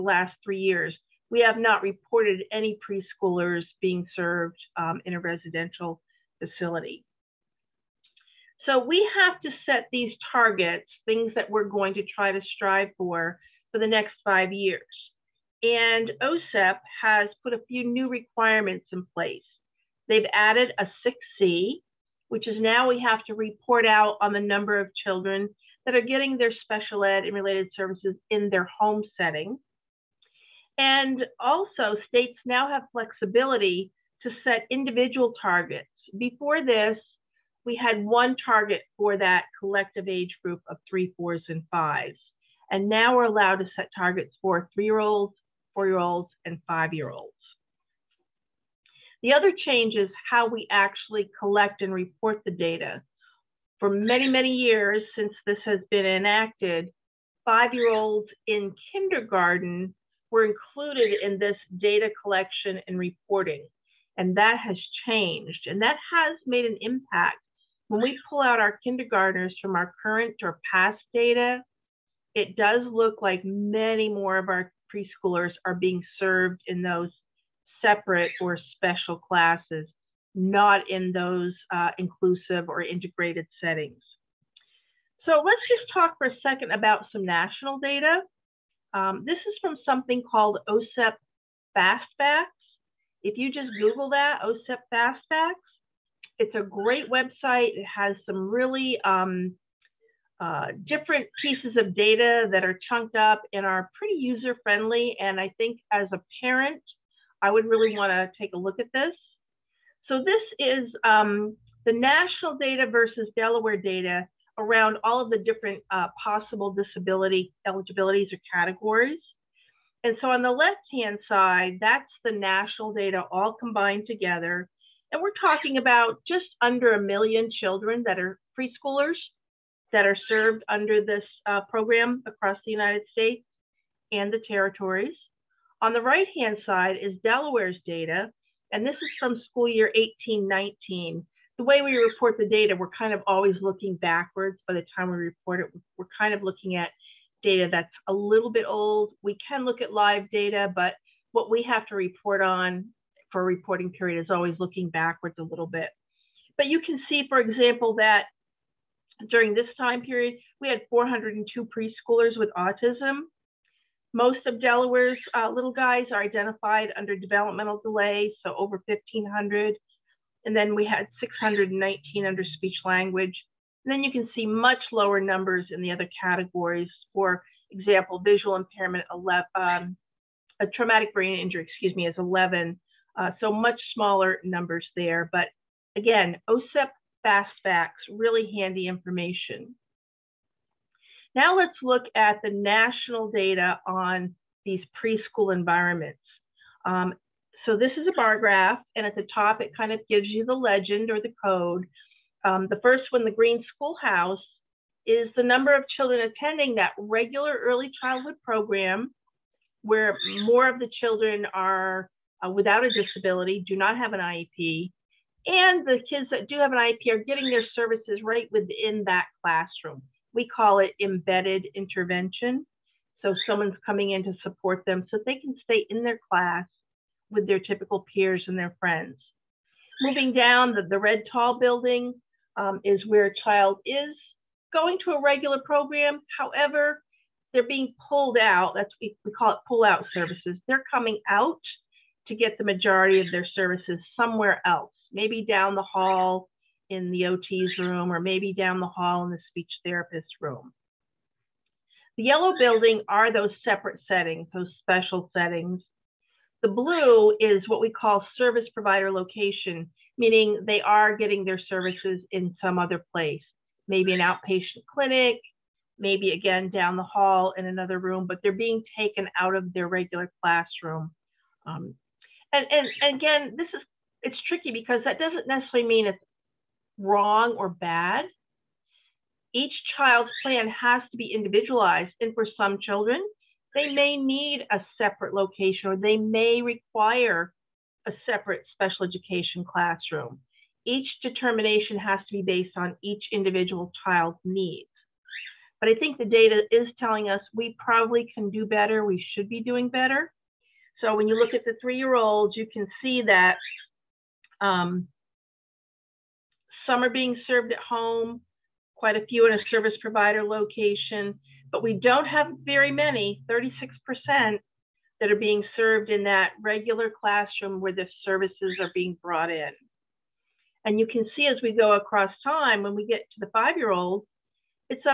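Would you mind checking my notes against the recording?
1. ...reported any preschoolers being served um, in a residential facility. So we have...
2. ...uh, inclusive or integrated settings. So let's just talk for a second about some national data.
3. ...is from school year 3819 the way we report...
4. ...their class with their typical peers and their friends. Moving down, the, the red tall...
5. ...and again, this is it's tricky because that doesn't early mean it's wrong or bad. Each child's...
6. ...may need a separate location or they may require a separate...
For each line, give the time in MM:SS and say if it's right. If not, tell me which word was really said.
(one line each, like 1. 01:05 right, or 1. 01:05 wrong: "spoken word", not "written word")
1. 00:01 right
2. 01:21 right
3. 02:18 wrong: "1819", not "3819"
4. 03:46 right
5. 04:32 wrong: "necessarily", not "early"
6. 04:43 right.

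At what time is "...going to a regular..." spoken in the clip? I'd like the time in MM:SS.
03:54.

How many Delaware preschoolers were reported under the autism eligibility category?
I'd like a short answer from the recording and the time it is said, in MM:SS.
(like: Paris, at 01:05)
402, at 02:40.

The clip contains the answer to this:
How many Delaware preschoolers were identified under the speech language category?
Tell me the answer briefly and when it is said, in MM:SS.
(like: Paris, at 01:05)
619, at 02:51.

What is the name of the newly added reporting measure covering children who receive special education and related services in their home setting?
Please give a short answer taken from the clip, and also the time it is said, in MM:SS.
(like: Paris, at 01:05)
6C, at 00:21.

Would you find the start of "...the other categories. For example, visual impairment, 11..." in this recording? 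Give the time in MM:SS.
02:55.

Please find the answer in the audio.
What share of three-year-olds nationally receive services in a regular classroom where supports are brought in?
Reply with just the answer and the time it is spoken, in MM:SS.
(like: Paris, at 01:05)
36%, at 05:13.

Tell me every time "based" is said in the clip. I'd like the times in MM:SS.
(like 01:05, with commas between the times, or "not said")
04:52.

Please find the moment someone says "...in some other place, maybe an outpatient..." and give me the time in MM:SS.
04:22.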